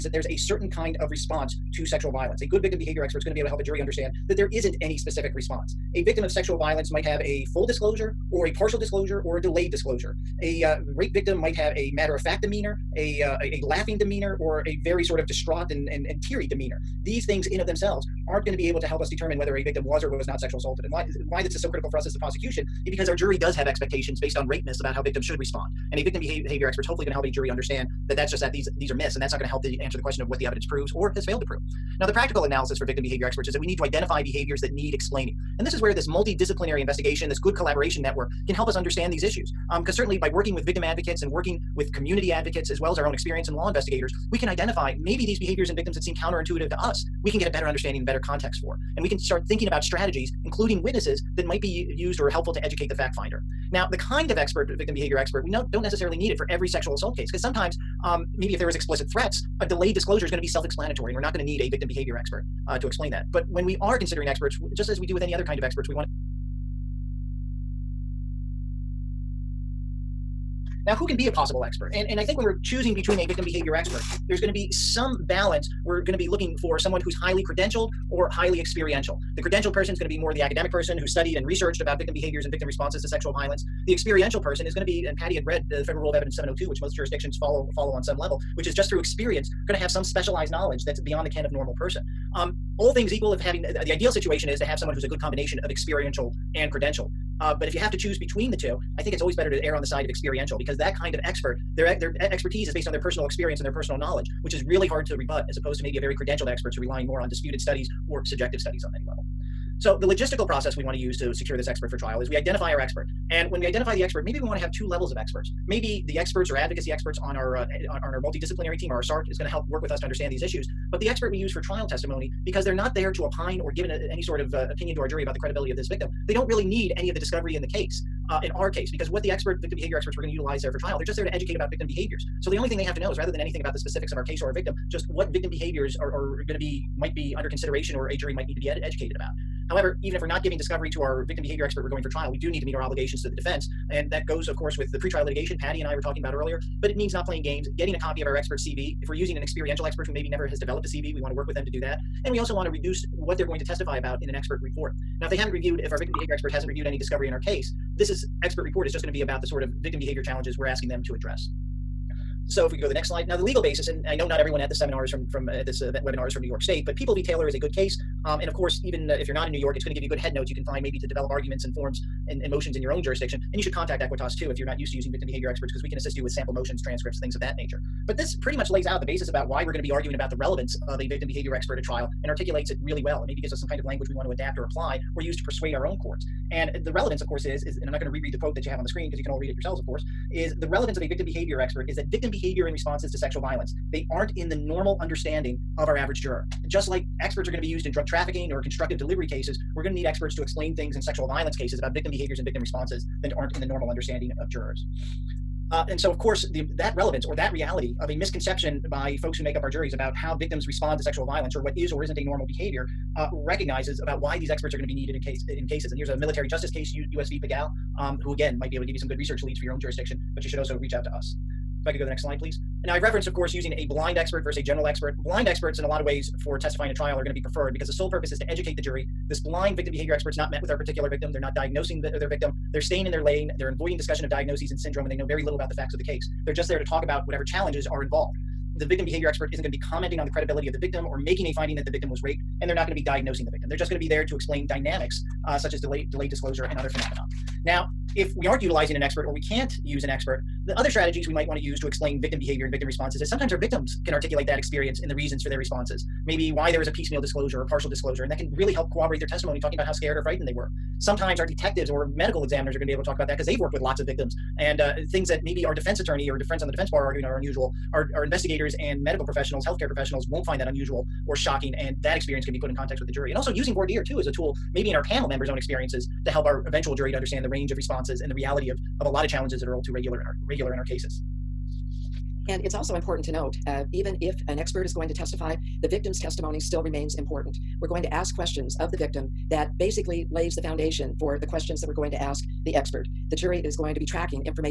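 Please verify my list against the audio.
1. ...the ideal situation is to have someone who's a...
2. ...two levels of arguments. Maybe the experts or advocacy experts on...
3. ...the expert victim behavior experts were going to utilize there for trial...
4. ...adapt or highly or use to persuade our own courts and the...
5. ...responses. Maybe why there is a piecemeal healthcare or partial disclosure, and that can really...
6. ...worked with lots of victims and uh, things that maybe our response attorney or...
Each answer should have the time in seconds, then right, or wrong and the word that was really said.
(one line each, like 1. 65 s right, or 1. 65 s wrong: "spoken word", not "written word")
1. 93 s right
2. 114 s wrong: "experts", not "arguments"
3. 129 s right
4. 184 s wrong: "apply", not "highly"
5. 255 s wrong: "disclosure", not "healthcare"
6. 263 s wrong: "defense", not "response".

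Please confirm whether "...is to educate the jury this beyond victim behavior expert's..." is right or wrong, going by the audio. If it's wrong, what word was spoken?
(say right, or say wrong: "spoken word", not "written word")
wrong: "blind", not "beyond".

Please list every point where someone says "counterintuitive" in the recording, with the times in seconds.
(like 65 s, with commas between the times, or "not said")
46 s.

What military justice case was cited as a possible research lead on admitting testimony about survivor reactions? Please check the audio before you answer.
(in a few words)
U.S. v. Pagal.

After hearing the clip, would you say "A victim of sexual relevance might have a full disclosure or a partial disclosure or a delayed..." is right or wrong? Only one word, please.
wrong.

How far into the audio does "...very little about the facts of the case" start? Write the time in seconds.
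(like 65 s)
235 s.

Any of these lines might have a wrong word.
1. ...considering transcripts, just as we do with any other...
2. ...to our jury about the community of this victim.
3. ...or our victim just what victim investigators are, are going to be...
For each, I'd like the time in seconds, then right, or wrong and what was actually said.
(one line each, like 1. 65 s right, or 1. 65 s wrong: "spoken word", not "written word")
1. 63 s wrong: "experts", not "transcripts"
2. 124 s wrong: "credibility", not "community"
3. 134 s wrong: "behaviors", not "investigators".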